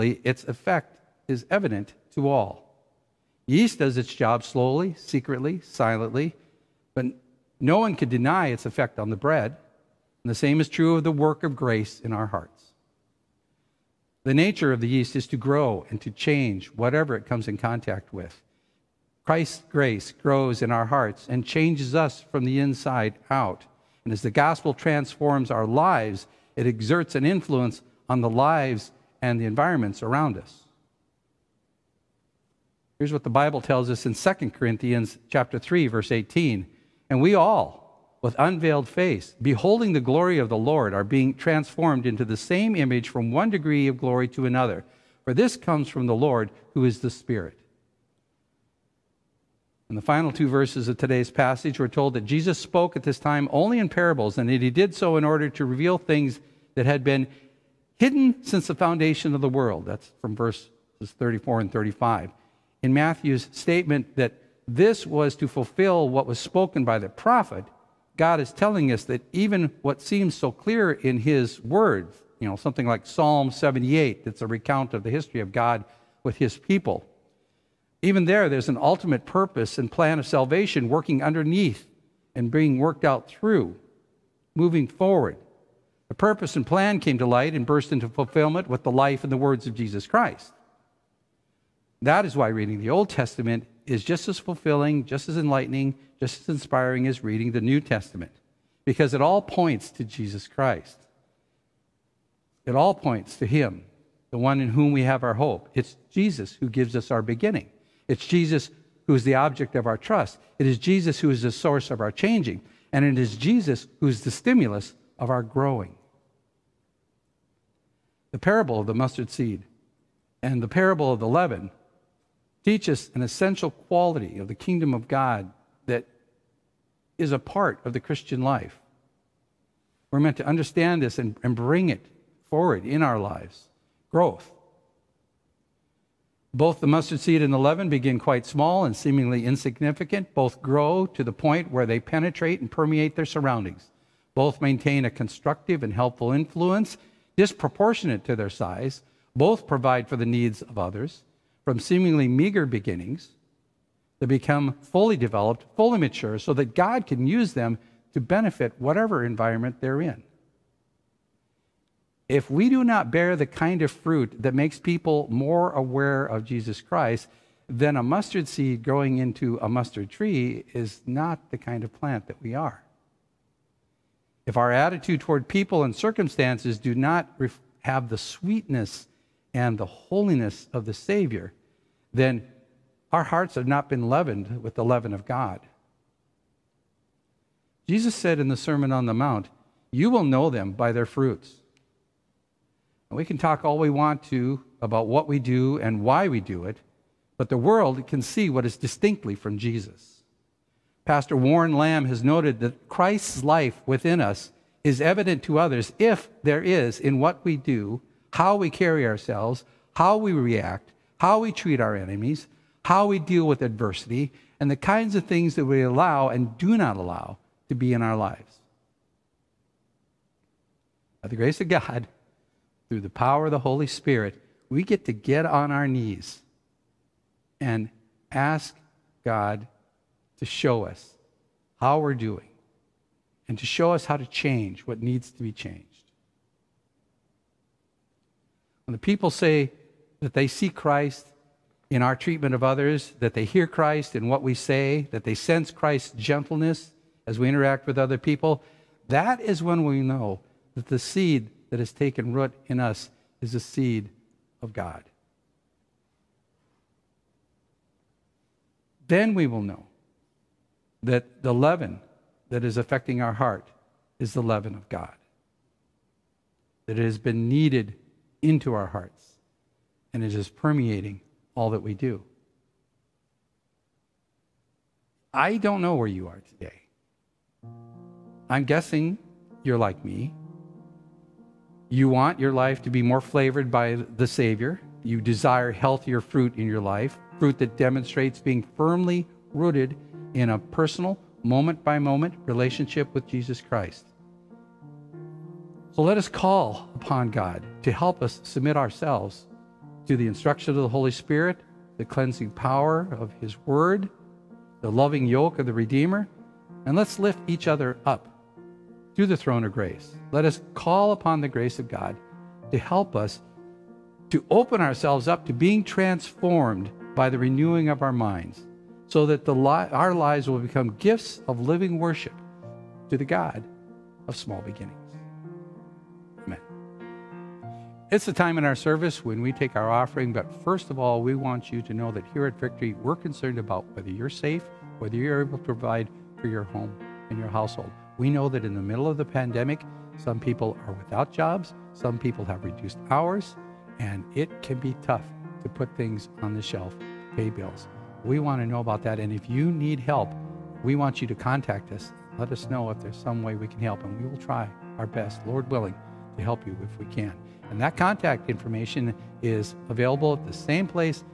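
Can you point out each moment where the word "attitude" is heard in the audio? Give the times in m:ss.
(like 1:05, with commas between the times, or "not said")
2:54.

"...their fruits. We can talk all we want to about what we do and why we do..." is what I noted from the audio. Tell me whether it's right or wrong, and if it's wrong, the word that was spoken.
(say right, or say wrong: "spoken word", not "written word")
right.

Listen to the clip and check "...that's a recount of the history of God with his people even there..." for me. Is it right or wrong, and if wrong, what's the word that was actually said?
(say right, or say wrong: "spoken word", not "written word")
right.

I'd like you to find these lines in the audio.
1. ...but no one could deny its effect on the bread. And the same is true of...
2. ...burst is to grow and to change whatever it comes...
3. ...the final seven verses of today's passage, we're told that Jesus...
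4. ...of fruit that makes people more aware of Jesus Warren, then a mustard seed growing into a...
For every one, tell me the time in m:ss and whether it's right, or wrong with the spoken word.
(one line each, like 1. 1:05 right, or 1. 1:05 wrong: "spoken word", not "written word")
1. 0:06 right
2. 0:14 wrong: "yeast", not "burst"
3. 0:49 wrong: "two", not "seven"
4. 2:43 wrong: "Christ", not "Warren".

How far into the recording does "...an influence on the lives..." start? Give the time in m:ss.
0:27.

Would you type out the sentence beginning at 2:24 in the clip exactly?
Both maintain a constructive and helpful influence disproportionate to their size.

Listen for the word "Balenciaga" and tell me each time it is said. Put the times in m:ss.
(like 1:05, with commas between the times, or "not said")
not said.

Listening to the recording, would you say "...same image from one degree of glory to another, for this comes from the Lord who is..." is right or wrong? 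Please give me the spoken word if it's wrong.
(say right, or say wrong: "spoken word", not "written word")
right.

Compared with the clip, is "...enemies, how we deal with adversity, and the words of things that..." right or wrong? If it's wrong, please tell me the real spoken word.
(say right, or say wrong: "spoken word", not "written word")
wrong: "kinds", not "words".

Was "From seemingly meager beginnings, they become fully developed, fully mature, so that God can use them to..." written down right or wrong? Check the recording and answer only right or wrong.
right.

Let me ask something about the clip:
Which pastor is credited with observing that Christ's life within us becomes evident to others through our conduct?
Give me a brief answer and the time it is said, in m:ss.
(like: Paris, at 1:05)
Warren Lamb, at 3:21.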